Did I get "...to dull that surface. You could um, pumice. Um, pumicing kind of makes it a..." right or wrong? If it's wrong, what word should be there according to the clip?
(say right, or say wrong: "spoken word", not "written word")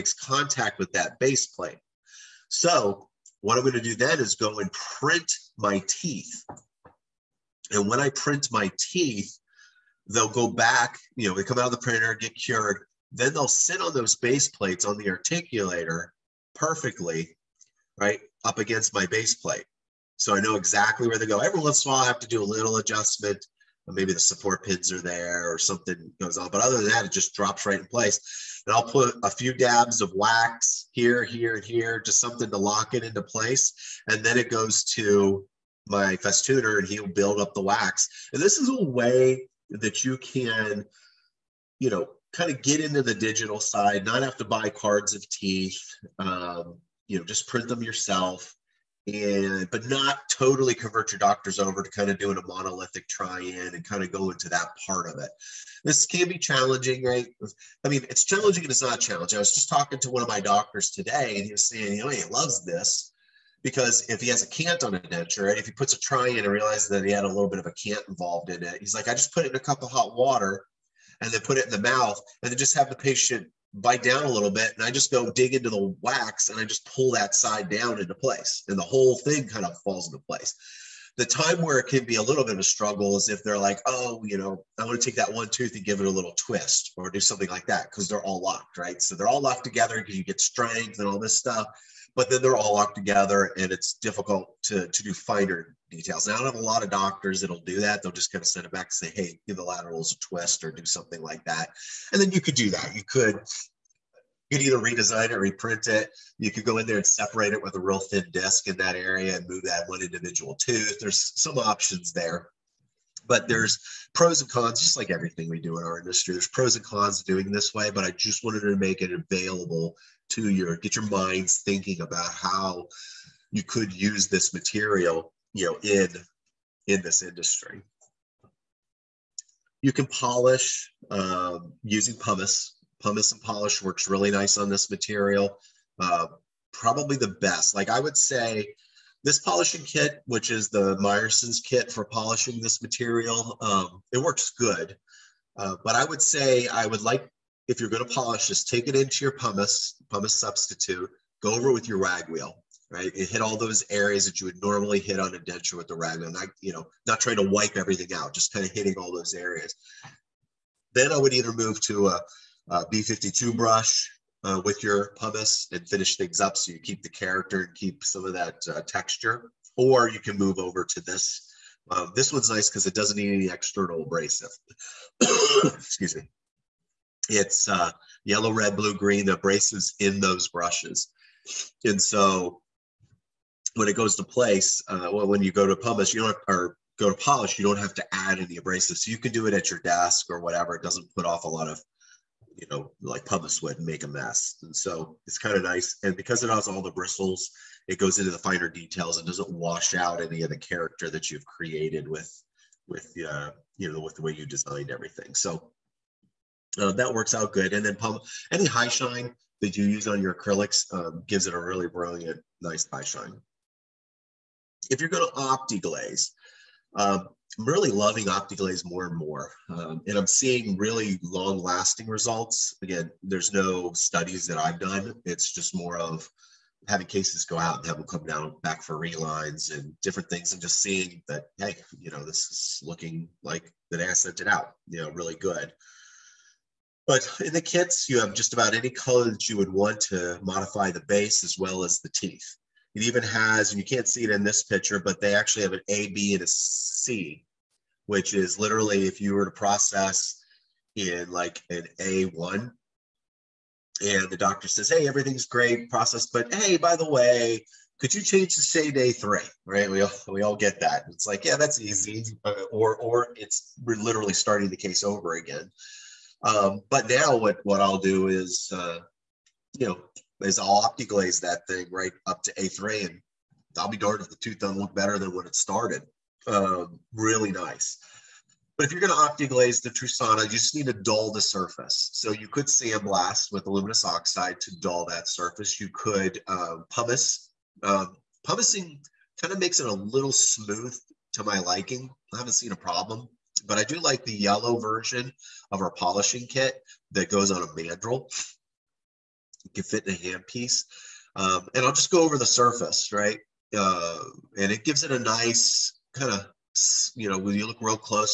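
right.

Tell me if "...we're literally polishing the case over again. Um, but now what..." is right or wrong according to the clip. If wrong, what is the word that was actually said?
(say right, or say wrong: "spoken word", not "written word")
wrong: "starting", not "polishing".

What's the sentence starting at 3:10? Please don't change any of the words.
It doesn't put off a lot of, you know, like pumice would make a mess.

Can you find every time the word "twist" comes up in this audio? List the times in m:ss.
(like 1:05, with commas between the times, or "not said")
1:26, 1:40.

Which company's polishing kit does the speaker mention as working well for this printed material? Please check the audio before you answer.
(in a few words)
Myerson's.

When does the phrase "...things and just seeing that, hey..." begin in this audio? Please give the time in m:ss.
3:50.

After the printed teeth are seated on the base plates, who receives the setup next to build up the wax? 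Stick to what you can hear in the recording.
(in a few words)
Festooner.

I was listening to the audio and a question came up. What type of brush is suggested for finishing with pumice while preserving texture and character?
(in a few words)
B52 brush.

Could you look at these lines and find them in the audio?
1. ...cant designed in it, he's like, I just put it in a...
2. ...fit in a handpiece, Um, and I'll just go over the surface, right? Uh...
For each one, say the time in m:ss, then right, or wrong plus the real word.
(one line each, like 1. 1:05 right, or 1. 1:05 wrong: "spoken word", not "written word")
1. 1:07 wrong: "involved", not "designed"
2. 4:59 right.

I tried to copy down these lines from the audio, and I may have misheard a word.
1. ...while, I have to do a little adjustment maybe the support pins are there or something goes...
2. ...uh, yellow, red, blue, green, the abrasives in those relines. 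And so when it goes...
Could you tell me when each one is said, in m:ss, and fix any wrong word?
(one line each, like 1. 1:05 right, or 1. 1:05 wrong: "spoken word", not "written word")
1. 0:21 right
2. 2:57 wrong: "brushes", not "relines".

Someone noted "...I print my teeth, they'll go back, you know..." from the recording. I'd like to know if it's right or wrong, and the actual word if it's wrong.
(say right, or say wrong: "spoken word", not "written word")
right.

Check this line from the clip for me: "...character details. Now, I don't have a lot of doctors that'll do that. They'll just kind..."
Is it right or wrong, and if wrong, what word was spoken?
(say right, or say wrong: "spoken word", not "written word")
wrong: "finer", not "character".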